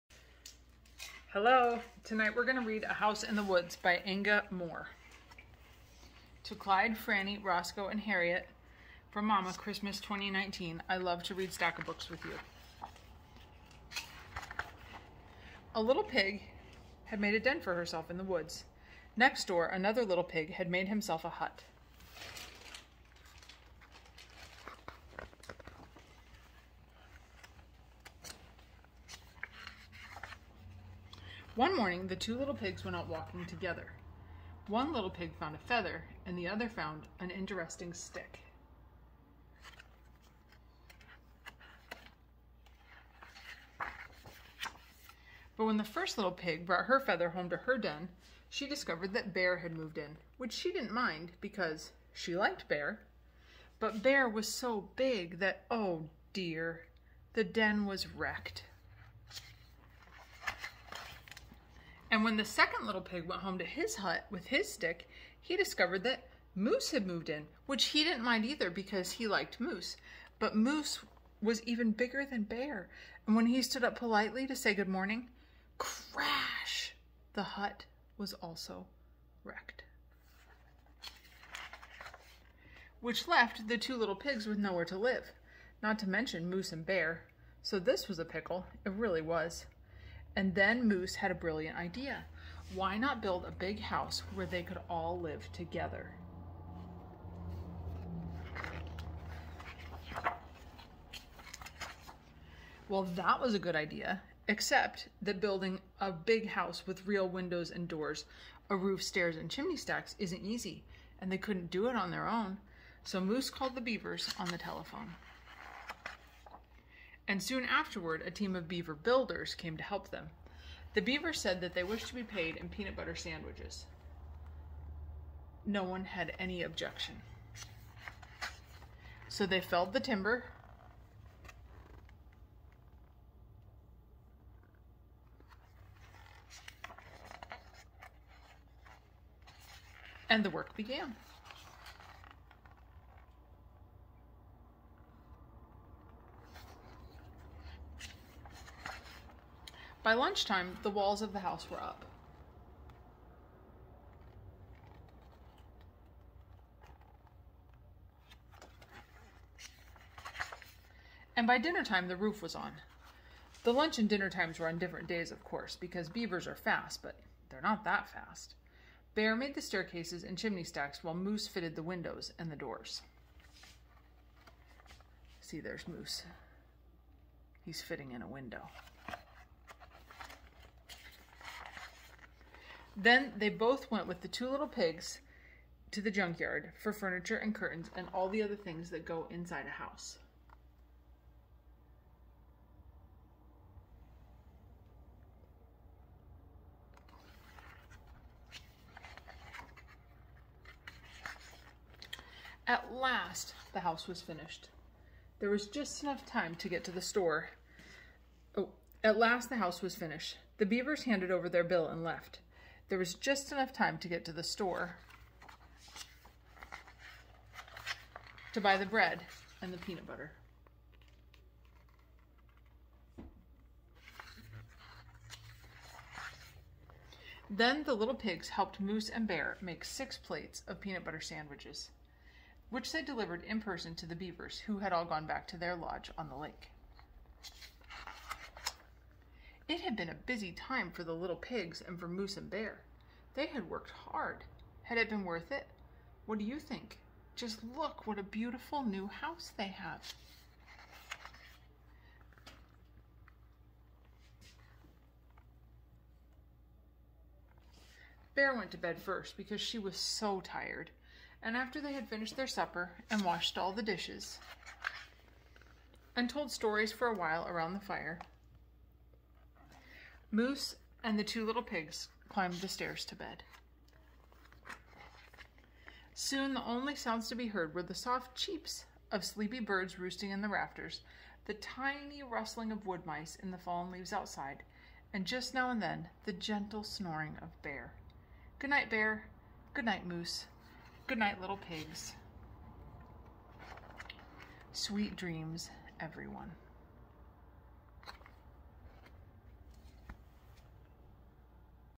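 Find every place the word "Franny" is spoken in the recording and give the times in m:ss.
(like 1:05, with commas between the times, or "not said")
0:06.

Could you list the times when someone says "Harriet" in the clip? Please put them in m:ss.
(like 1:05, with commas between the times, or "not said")
0:08.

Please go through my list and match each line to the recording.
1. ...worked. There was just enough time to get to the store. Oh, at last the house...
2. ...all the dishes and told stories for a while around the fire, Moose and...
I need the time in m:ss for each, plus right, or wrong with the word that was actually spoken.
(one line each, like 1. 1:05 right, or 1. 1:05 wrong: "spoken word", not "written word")
1. 3:24 wrong: "finished", not "worked"
2. 4:23 right.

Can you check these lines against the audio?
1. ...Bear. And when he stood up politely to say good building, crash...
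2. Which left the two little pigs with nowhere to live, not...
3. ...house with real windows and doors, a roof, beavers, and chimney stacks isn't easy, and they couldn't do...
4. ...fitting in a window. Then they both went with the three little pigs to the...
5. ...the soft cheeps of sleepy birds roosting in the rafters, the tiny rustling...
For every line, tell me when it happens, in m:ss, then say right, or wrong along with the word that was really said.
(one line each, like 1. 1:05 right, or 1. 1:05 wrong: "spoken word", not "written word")
1. 1:12 wrong: "morning", not "building"
2. 1:22 right
3. 1:46 wrong: "stairs", not "beavers"
4. 2:57 wrong: "two", not "three"
5. 4:37 right.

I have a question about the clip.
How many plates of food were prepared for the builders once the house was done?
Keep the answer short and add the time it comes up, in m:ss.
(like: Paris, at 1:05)
6, at 3:49.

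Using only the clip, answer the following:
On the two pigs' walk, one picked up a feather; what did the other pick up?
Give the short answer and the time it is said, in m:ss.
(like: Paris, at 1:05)
An interesting stick, at 0:37.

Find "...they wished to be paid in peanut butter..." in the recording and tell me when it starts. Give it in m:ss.
2:01.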